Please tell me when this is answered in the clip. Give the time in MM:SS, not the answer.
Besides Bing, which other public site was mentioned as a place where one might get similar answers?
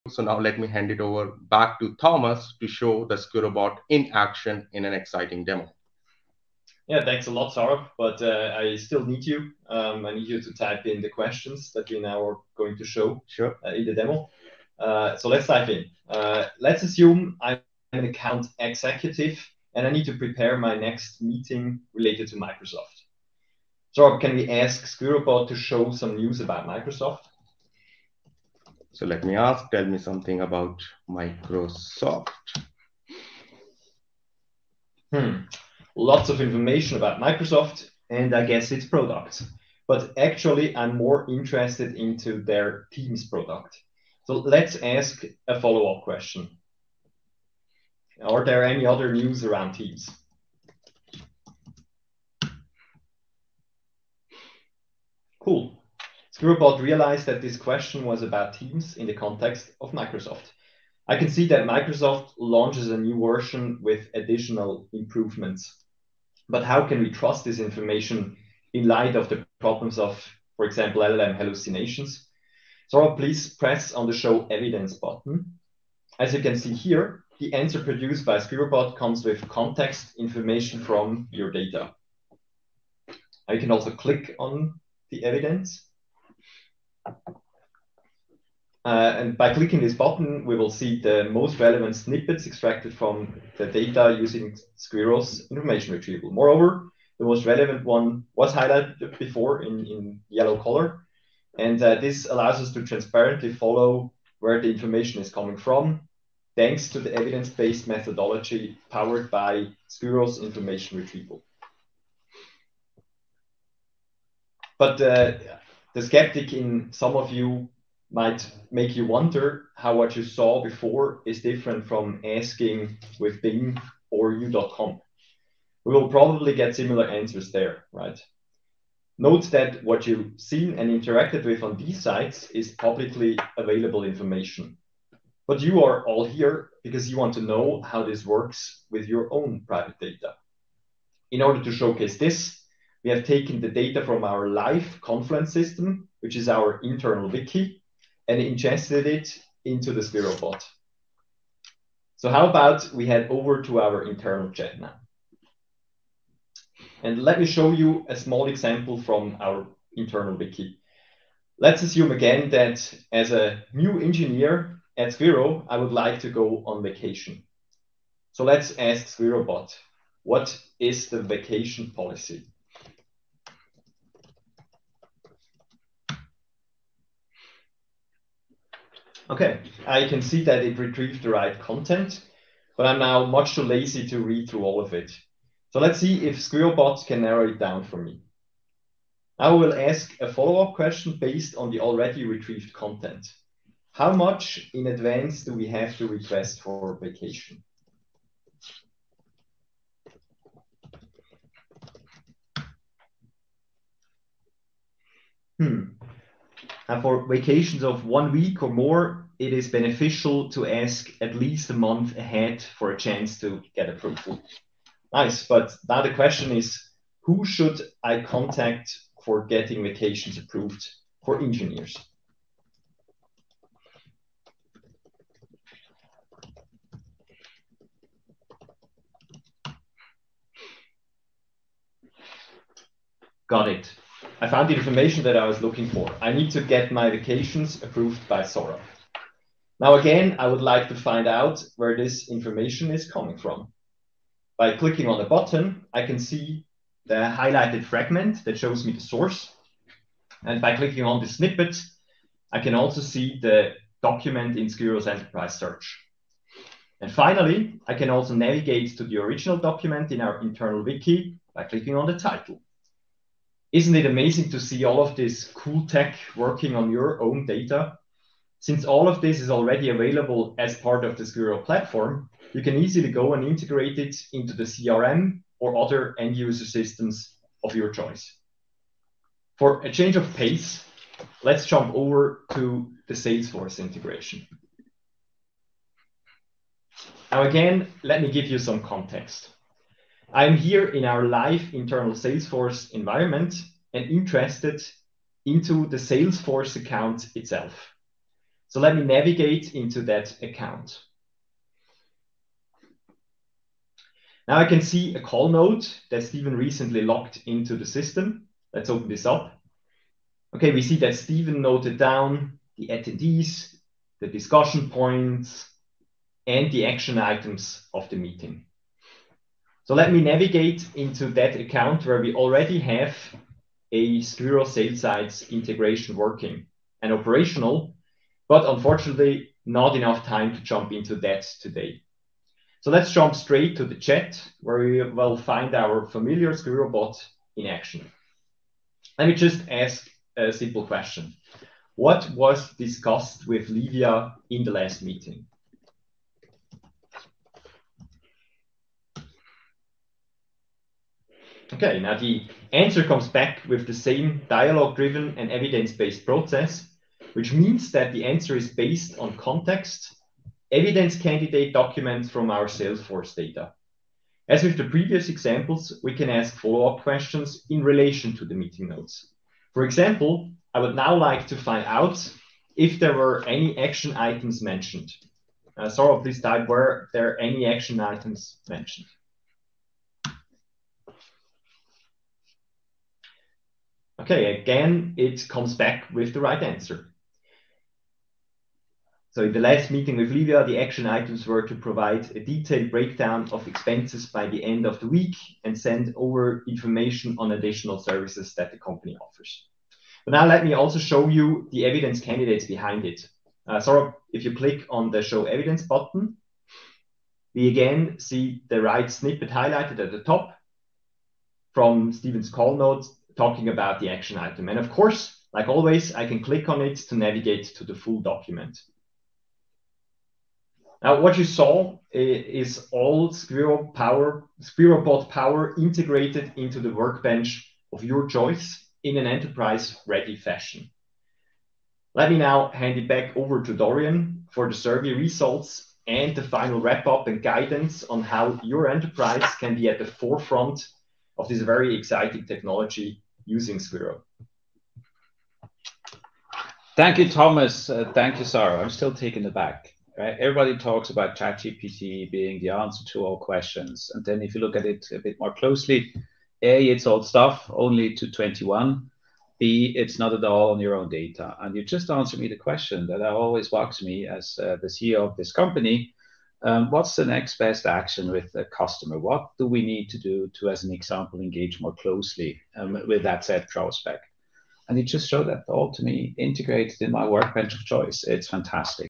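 02:04.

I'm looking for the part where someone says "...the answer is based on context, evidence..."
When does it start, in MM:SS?
05:58.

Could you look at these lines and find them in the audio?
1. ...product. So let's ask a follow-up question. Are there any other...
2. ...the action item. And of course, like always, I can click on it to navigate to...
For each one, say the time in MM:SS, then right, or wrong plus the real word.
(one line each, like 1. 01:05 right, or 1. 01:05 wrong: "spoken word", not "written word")
1. 00:43 right
2. 06:53 right.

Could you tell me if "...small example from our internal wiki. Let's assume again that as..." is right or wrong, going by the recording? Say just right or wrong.
right.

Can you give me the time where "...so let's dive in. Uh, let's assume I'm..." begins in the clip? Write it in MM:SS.
00:15.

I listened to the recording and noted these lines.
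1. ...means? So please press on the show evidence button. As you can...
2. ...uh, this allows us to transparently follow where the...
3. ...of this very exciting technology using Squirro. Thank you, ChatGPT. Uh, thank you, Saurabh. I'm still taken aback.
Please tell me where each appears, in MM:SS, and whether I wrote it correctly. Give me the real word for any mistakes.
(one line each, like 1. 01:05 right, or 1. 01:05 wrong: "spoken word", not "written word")
1. 01:11 wrong: "hallucinations", not "means"
2. 01:41 right
3. 07:21 wrong: "Thomas", not "ChatGPT".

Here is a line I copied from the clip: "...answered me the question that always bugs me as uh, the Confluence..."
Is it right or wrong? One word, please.
wrong.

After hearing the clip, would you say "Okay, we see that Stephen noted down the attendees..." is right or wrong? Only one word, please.
right.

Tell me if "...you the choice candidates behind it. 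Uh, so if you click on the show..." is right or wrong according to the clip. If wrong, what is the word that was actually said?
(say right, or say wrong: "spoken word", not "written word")
wrong: "evidence", not "choice".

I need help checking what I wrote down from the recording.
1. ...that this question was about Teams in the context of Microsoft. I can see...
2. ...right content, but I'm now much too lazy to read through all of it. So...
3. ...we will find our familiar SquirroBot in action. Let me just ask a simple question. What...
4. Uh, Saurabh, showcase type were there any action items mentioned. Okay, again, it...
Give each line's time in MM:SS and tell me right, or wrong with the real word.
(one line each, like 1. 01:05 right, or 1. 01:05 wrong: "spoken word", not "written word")
1. 00:57 right
2. 03:01 right
3. 05:34 right
4. 06:15 wrong: "please", not "showcase".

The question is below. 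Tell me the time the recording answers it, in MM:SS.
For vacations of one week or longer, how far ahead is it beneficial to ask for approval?
03:31.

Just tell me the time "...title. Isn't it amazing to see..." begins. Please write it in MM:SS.
04:22.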